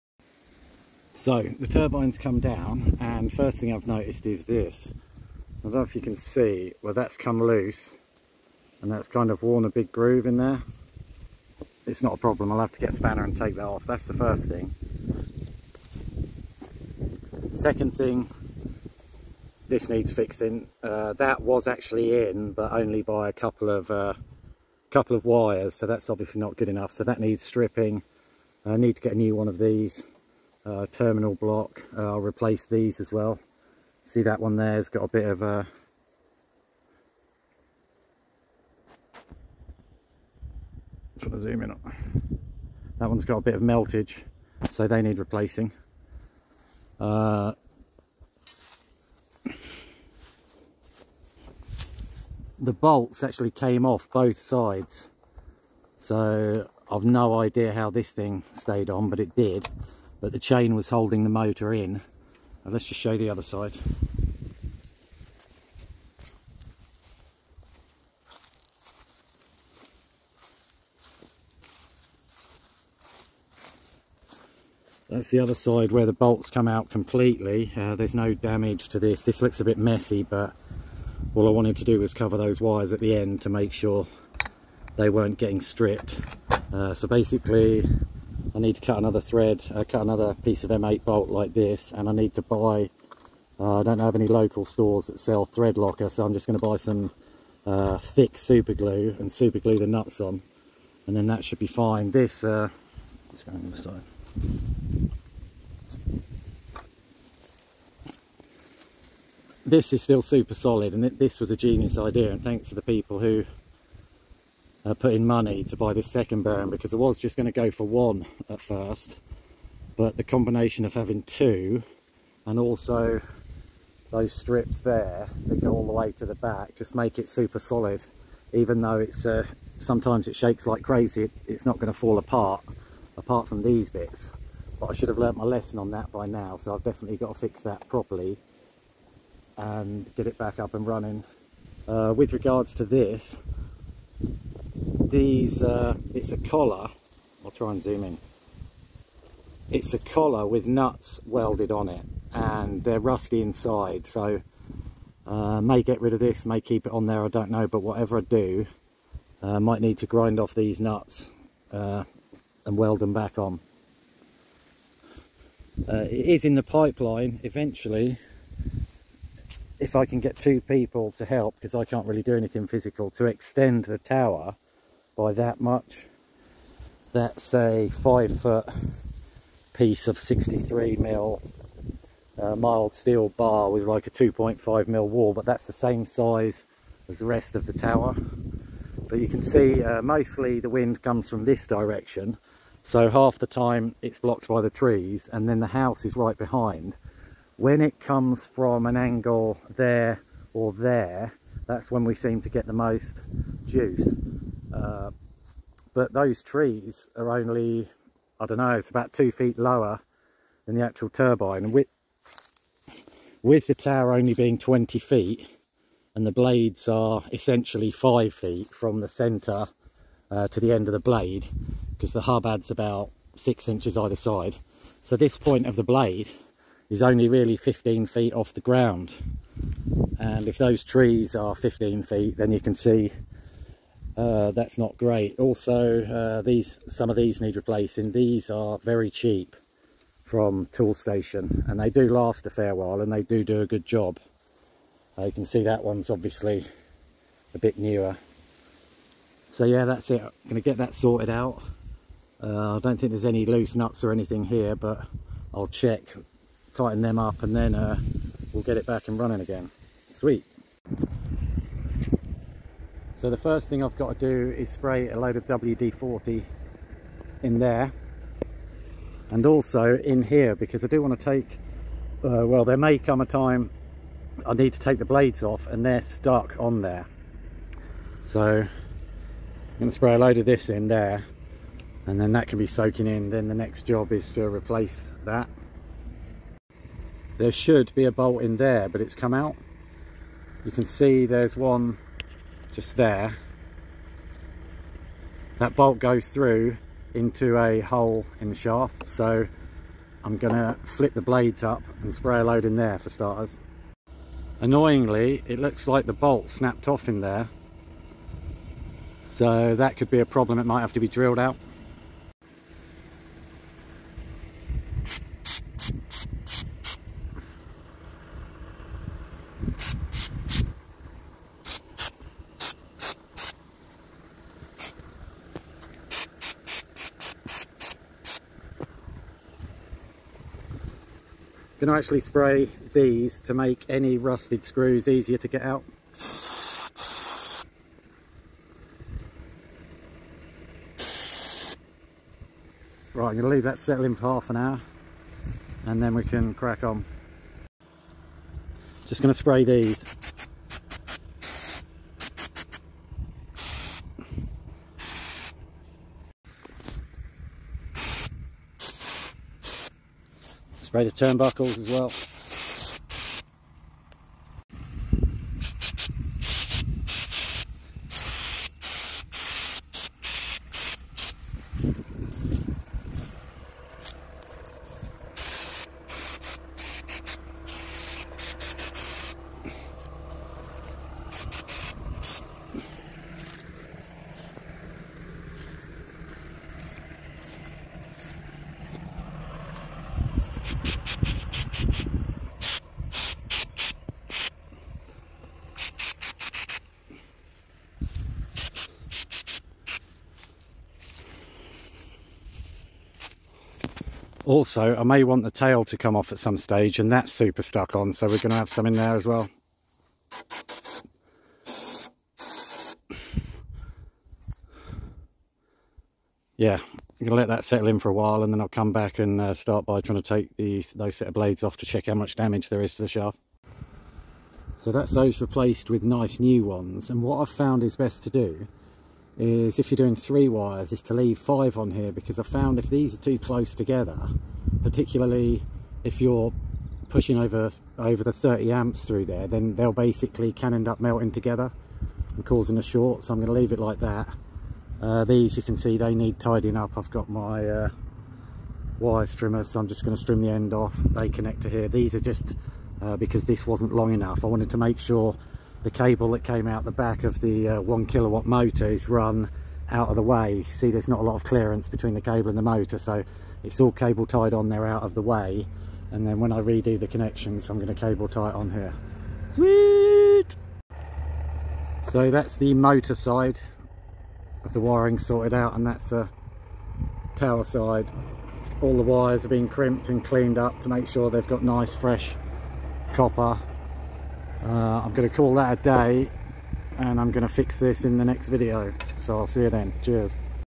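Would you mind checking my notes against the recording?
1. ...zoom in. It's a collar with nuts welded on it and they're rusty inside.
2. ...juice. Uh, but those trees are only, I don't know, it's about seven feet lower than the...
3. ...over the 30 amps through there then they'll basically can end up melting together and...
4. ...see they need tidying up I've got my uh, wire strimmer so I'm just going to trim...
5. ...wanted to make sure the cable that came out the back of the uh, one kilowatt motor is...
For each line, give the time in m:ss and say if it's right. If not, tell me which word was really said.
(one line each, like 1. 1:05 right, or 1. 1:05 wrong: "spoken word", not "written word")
1. 2:27 right
2. 3:23 wrong: "two", not "seven"
3. 7:17 right
4. 7:25 right
5. 7:34 right.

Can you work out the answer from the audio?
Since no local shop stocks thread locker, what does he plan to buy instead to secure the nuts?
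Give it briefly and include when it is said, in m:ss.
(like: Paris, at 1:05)
thick super glue, at 1:37.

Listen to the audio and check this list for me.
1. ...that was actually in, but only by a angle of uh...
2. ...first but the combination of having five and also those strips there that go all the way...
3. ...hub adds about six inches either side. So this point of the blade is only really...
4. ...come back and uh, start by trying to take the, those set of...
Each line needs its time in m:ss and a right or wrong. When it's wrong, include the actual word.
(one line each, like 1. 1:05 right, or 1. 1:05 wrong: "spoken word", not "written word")
1. 0:21 wrong: "couple", not "angle"
2. 1:58 wrong: "two", not "five"
3. 3:42 right
4. 6:58 right.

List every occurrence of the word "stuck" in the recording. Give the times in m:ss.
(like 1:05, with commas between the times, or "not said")
4:36, 6:47.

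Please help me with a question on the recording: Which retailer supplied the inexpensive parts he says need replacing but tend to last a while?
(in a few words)
Toolstation.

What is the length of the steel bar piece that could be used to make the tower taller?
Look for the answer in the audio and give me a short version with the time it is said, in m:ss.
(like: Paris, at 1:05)
five foot, at 2:57.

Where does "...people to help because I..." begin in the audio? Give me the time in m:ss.
2:50.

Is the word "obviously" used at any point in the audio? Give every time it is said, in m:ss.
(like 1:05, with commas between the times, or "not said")
0:26, 4:06.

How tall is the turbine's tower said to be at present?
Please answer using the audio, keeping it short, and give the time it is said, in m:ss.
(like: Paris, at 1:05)
20 feet, at 3:34.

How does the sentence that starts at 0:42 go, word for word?
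That one's got a bit of meltage, so they need replacing.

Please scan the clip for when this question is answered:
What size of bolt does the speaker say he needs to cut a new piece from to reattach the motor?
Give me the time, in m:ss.
1:30.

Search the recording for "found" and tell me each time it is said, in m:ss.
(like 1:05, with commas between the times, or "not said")
7:07, 7:12.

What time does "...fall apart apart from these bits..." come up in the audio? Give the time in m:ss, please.
2:11.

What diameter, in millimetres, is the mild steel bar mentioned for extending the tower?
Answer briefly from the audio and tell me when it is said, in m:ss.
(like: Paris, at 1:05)
63, at 3:00.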